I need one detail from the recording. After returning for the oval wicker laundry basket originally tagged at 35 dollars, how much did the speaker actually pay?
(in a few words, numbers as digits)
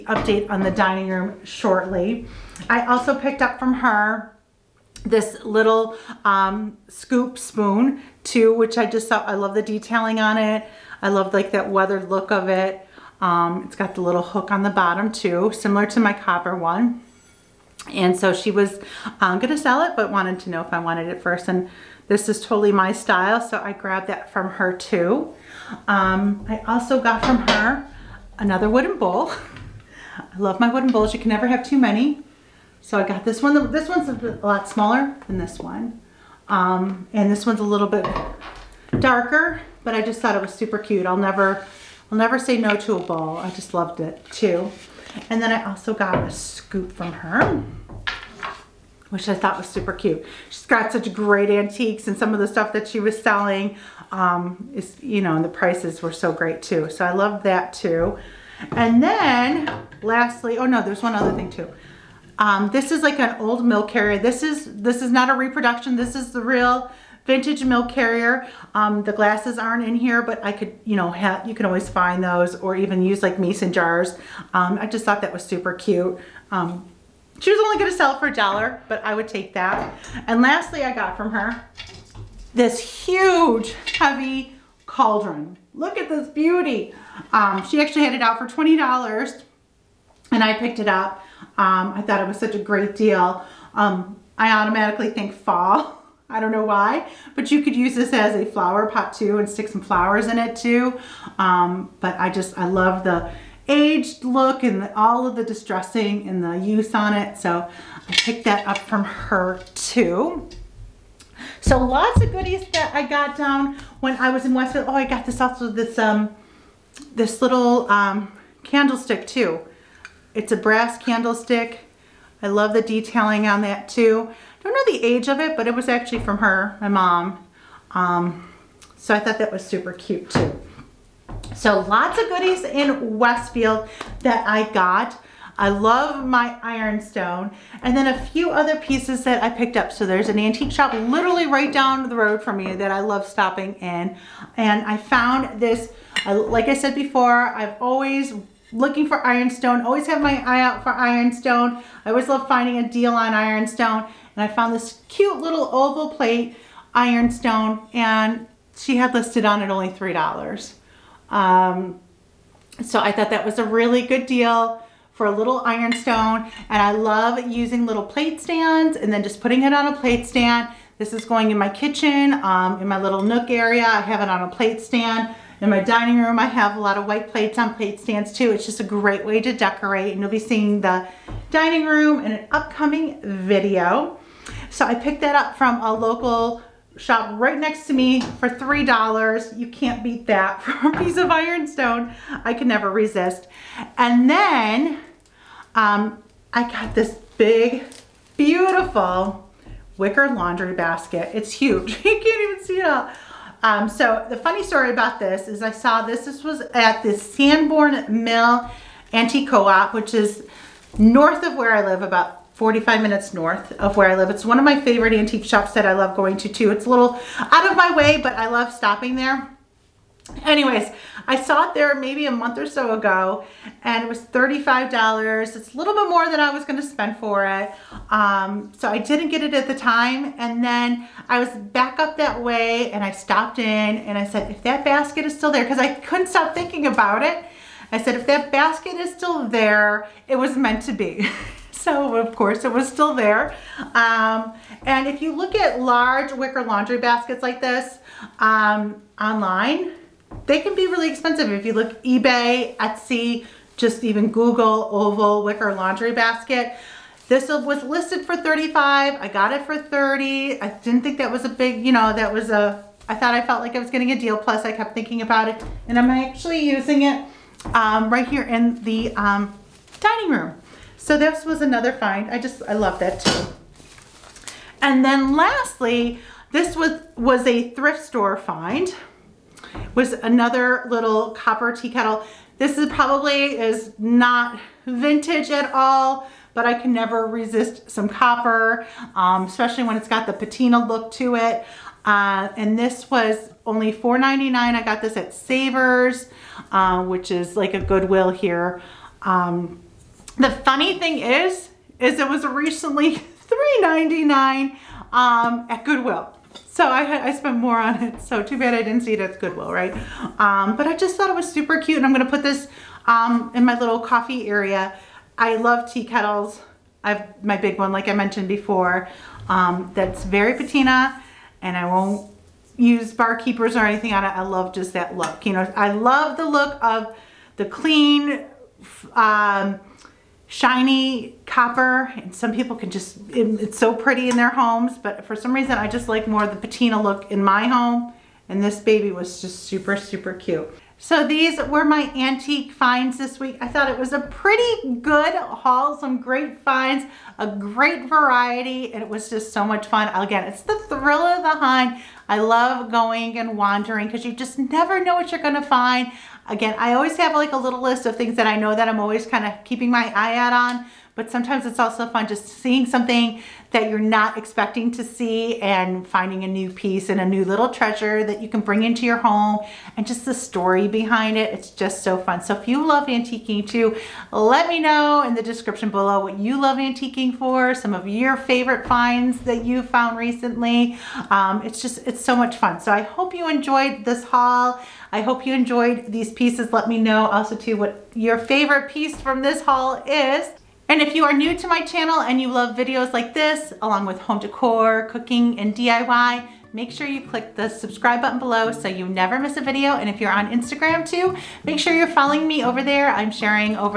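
$30.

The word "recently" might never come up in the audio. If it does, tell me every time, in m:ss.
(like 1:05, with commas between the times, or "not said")
5:02, 6:20.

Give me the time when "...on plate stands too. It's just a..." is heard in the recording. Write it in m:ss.
2:57.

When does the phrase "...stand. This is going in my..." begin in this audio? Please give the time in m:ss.
2:50.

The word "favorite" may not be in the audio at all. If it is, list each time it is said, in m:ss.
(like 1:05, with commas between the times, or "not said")
3:34, 6:18, 6:28.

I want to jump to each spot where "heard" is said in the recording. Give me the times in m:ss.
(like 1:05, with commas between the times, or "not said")
not said.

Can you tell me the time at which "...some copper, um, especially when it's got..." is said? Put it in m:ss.
4:47.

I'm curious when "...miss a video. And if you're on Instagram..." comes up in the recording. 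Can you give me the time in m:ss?
6:39.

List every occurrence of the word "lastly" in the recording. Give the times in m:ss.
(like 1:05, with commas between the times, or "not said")
1:00, 1:20, 4:35.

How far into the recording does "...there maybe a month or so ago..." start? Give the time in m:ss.
3:41.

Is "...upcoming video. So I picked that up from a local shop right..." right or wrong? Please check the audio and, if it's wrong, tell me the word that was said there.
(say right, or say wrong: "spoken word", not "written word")
right.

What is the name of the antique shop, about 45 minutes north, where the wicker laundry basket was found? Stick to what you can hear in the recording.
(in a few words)
Sanborn Mill Antique Co-op.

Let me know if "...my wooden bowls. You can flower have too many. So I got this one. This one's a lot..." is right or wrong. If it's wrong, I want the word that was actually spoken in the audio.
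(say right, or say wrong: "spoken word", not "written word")
wrong: "never", not "flower".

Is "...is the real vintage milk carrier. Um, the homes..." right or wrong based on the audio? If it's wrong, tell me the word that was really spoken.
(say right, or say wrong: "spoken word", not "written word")
wrong: "glasses", not "homes".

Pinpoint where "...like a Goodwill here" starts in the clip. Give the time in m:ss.
4:57.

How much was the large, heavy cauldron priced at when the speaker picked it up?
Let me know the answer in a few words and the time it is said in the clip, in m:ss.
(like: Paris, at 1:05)
$20, at 1:28.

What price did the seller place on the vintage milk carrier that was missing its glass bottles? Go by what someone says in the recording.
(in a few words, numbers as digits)
$1.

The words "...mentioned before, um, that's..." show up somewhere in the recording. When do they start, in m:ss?
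5:18.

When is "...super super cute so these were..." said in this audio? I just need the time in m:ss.
5:39.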